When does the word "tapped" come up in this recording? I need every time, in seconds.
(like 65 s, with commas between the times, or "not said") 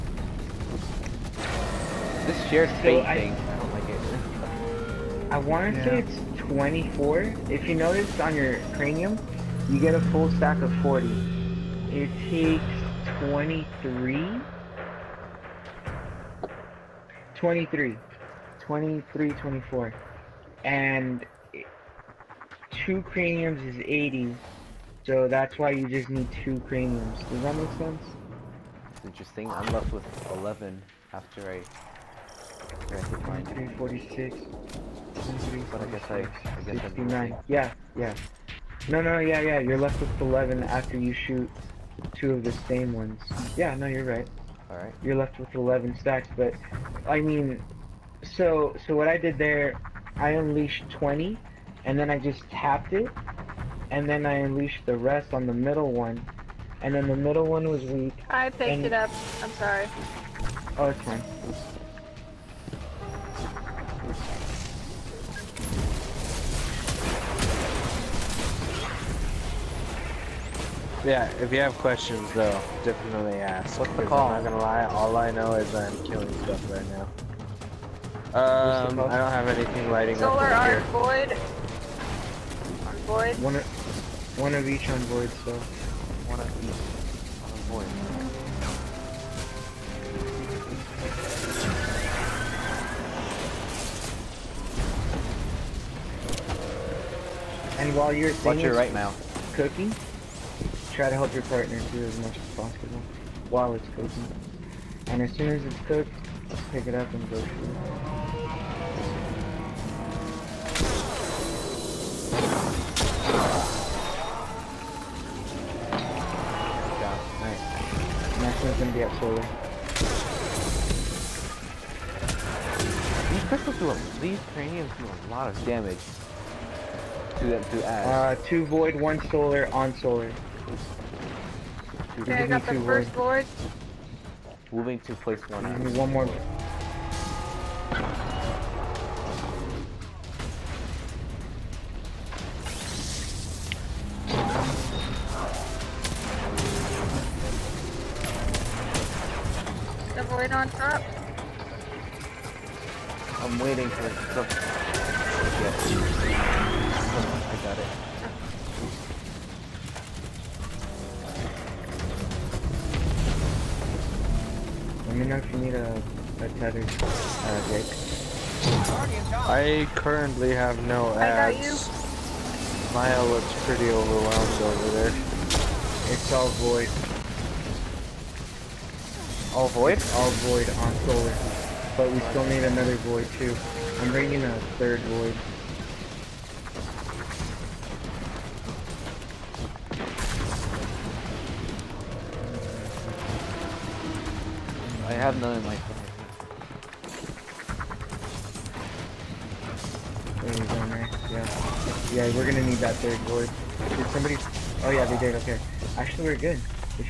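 52 s.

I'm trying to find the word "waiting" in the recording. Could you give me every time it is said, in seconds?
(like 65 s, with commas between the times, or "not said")
153 s.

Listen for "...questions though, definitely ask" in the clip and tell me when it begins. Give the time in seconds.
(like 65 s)
71 s.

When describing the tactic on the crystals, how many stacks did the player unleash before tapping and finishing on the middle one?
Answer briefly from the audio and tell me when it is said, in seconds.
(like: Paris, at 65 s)
20, at 50 s.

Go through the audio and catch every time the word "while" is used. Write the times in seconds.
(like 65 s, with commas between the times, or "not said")
97 s, 103 s.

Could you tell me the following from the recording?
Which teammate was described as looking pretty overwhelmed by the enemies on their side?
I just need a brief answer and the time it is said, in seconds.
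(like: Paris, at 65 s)
Maya, at 172 s.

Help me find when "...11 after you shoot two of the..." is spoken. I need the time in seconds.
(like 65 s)
40 s.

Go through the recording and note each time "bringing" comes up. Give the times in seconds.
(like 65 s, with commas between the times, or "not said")
184 s.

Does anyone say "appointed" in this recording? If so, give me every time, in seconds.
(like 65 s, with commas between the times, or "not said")
not said.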